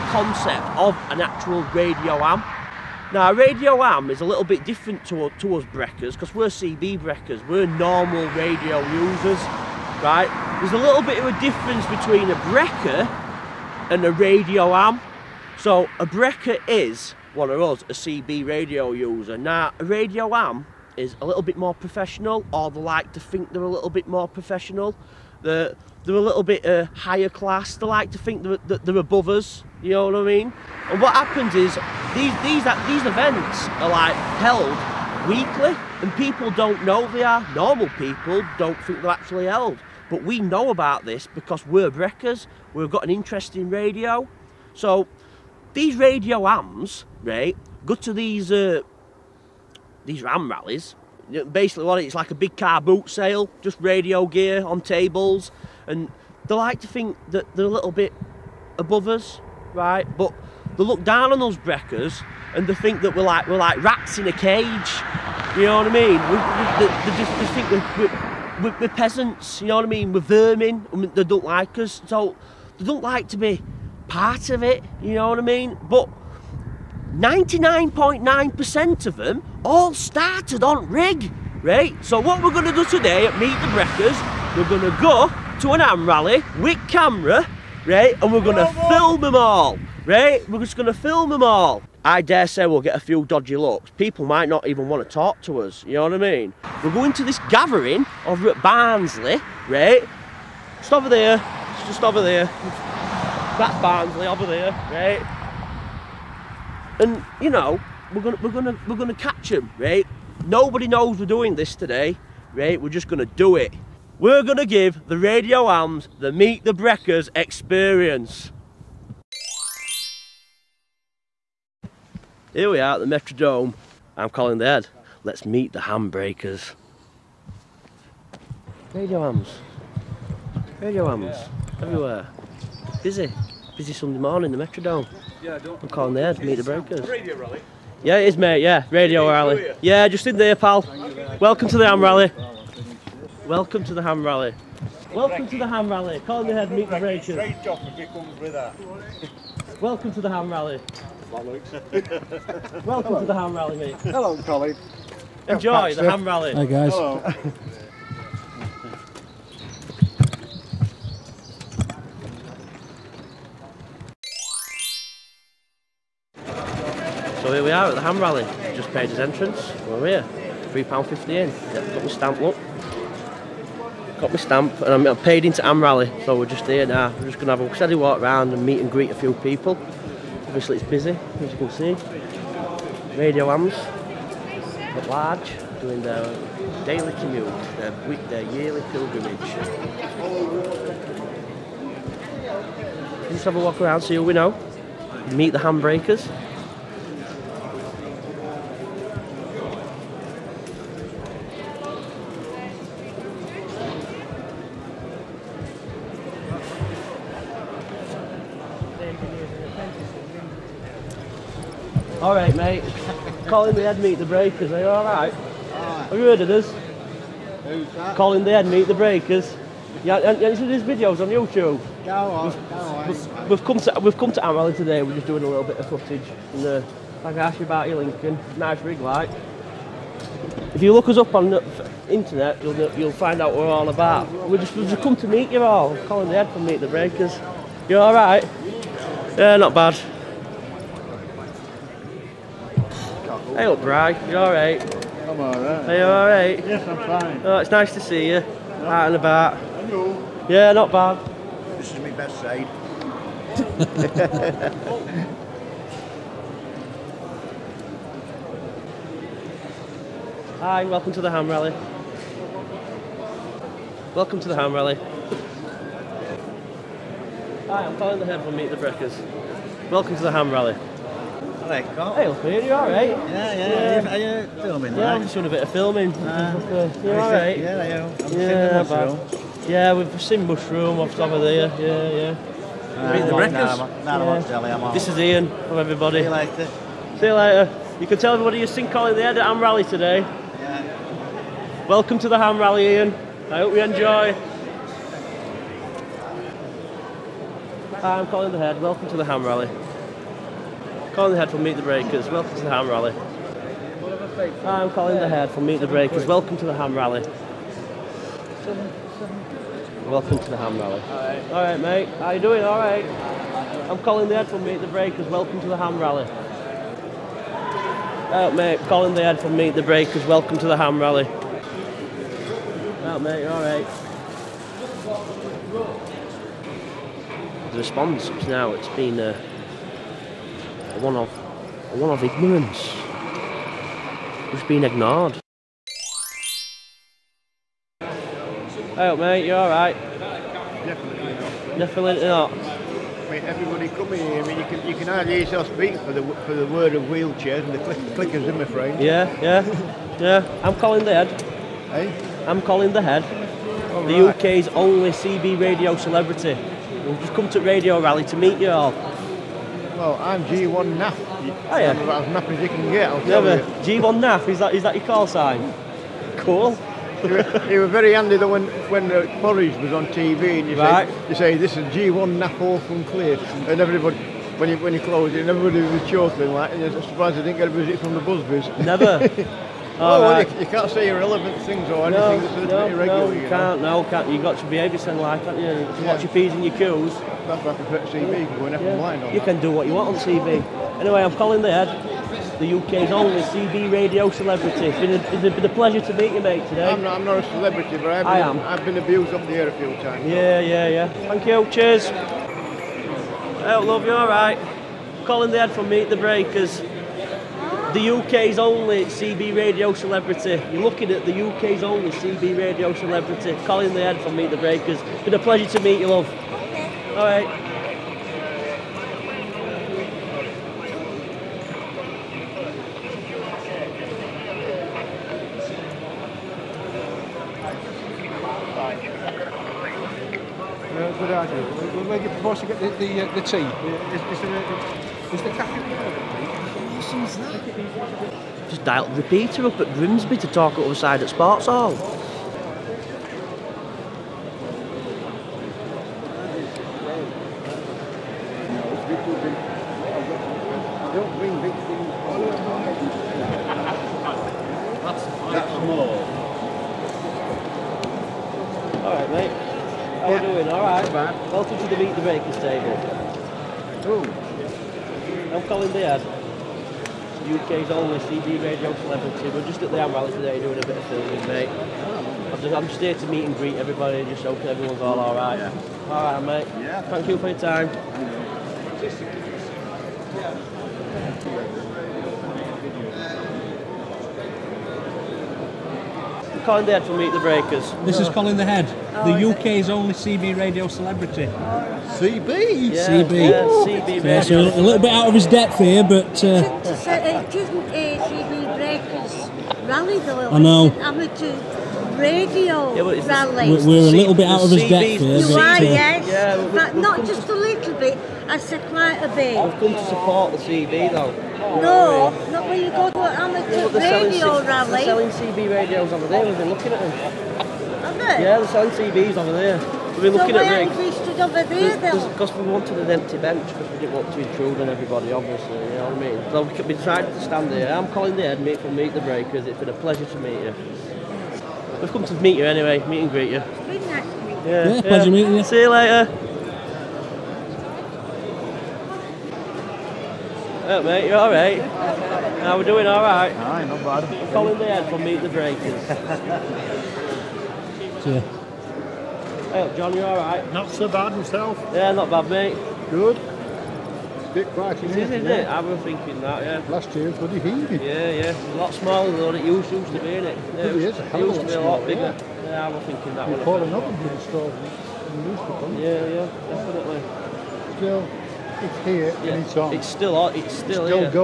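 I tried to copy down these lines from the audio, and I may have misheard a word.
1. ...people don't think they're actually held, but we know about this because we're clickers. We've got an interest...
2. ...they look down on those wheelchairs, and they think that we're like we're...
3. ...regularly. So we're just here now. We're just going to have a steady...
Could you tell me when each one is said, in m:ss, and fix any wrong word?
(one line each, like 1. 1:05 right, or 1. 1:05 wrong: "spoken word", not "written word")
1. 0:37 wrong: "breakers", not "clickers"
2. 1:00 wrong: "brekkers", not "wheelchairs"
3. 2:55 wrong: "rally", not "regularly".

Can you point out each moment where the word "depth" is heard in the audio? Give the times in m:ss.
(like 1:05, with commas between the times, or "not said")
8:15, 8:24.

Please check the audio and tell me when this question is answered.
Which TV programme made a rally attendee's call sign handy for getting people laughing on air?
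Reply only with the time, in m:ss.
6:09.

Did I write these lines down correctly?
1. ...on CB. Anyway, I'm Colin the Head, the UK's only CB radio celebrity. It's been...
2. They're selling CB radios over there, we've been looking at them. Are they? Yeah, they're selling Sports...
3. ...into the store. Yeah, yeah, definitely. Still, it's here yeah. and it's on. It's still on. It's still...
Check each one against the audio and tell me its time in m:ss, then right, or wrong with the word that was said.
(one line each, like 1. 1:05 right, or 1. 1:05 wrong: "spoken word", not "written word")
1. 6:30 right
2. 8:35 wrong: "CBs", not "Sports"
3. 9:24 right.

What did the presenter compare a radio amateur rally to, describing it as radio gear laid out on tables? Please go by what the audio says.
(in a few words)
a big car boot sale.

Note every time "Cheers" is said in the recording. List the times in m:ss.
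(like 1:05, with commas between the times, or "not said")
6:41, 9:08.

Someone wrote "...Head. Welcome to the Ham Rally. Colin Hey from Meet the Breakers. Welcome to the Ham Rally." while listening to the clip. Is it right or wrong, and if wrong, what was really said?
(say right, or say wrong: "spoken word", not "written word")
wrong: "Head", not "Hey".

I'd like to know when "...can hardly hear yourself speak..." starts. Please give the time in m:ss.
5:44.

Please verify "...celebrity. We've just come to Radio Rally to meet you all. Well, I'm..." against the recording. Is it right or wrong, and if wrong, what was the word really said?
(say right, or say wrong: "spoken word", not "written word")
right.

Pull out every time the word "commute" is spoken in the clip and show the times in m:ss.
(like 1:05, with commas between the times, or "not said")
3:07.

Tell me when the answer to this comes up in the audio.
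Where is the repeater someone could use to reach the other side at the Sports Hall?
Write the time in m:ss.
7:19.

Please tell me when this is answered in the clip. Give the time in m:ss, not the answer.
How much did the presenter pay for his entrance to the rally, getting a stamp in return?
2:50.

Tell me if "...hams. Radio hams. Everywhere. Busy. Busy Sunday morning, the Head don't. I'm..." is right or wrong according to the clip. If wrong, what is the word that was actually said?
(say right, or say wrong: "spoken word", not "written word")
wrong: "Metrodome", not "Head".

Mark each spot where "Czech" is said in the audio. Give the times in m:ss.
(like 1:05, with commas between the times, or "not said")
not said.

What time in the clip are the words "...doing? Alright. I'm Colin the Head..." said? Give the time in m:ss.
5:12.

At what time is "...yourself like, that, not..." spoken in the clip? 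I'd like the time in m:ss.
6:24.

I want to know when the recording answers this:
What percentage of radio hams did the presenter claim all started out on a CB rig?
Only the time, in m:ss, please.
1:17.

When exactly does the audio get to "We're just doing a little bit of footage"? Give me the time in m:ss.
3:45.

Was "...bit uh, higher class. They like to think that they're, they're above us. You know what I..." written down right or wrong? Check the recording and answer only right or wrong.
right.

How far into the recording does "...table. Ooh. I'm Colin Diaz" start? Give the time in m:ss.
7:42.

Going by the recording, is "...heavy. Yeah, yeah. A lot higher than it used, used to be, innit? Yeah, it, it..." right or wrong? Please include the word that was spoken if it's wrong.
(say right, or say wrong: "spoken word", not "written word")
wrong: "smaller", not "higher".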